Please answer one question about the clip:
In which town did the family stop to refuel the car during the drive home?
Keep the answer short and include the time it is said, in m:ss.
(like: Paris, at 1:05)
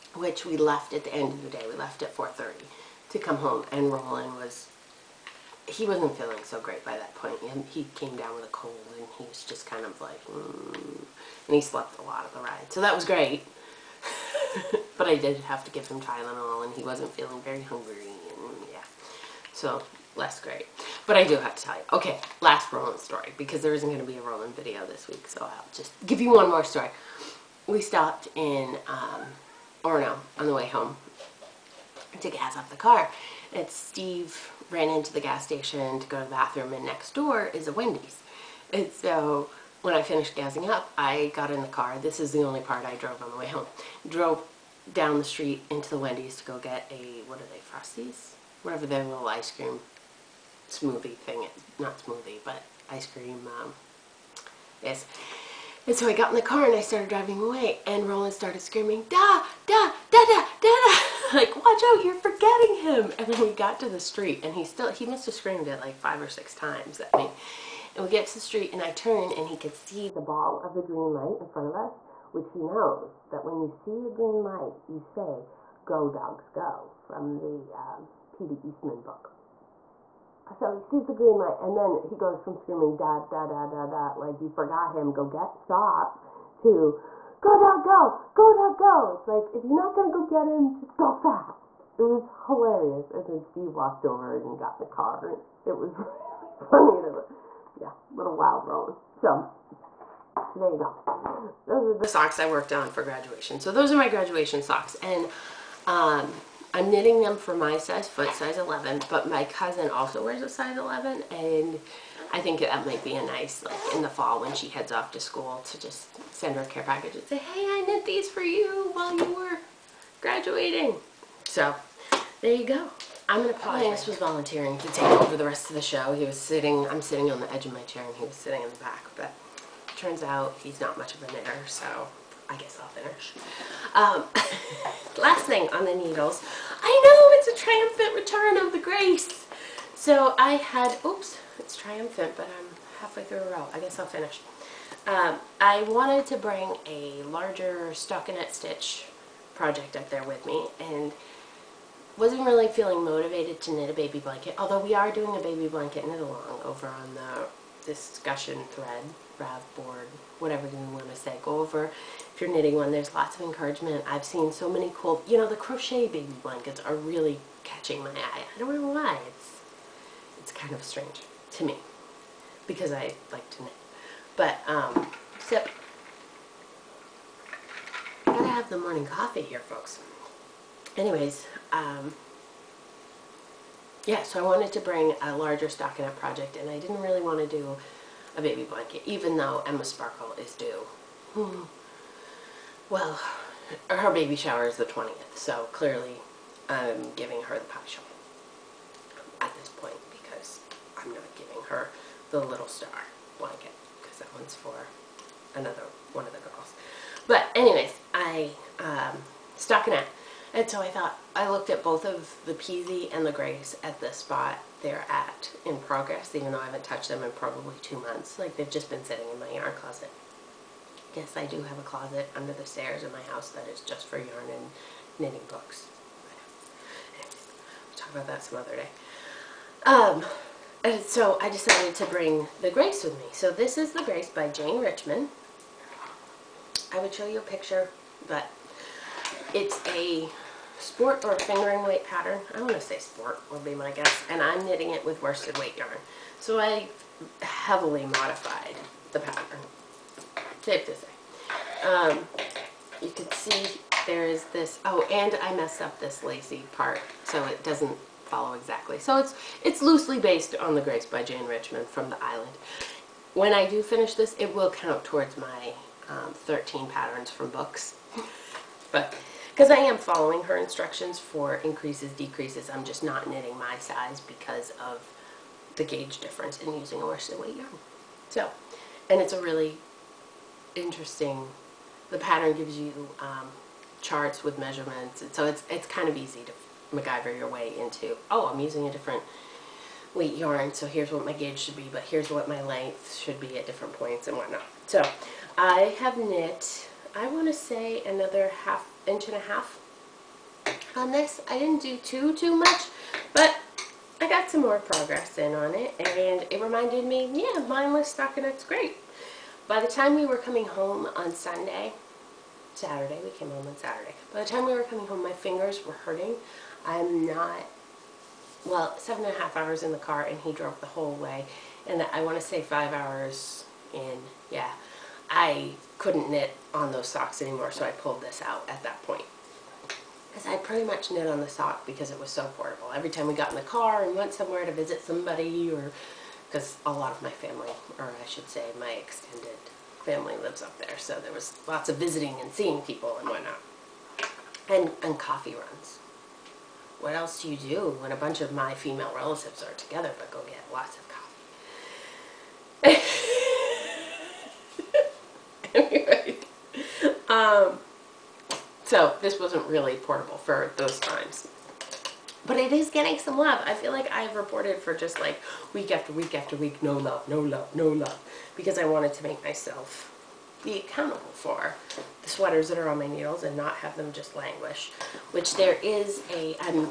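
Orono, at 0:29.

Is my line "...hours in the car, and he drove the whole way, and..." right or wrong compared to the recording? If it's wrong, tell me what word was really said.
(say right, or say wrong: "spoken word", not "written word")
right.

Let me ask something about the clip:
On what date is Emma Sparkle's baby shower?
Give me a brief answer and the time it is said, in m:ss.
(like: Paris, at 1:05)
the 20th, at 3:14.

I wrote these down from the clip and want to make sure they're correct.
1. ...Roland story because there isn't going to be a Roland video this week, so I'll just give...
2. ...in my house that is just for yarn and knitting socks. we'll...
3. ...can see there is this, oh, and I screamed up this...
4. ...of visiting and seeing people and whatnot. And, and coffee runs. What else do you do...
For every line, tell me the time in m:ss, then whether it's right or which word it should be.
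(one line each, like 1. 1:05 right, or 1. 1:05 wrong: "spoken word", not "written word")
1. 0:22 right
2. 3:43 wrong: "books", not "socks"
3. 4:13 wrong: "messed", not "screamed"
4. 5:41 right.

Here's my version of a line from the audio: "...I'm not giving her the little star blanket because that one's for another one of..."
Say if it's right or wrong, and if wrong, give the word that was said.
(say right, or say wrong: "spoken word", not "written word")
right.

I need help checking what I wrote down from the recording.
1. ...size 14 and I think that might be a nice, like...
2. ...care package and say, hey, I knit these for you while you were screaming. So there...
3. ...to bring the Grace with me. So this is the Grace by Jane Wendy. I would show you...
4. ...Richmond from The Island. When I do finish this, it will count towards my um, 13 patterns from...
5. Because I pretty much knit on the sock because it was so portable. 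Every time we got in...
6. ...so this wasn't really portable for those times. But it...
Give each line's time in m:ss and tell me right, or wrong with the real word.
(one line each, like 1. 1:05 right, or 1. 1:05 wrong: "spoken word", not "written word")
1. 1:50 wrong: "11", not "14"
2. 1:56 wrong: "graduating", not "screaming"
3. 3:51 wrong: "Richmond", not "Wendy"
4. 4:21 right
5. 5:30 right
6. 5:58 right.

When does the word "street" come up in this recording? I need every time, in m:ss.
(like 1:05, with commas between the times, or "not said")
0:45, 1:03, 1:08.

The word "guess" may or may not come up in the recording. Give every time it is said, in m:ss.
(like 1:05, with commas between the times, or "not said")
2:12, 2:23, 4:03.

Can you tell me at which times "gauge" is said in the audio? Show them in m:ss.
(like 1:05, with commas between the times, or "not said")
4:35, 4:51.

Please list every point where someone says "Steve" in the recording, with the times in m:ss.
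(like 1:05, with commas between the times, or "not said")
0:33, 1:33.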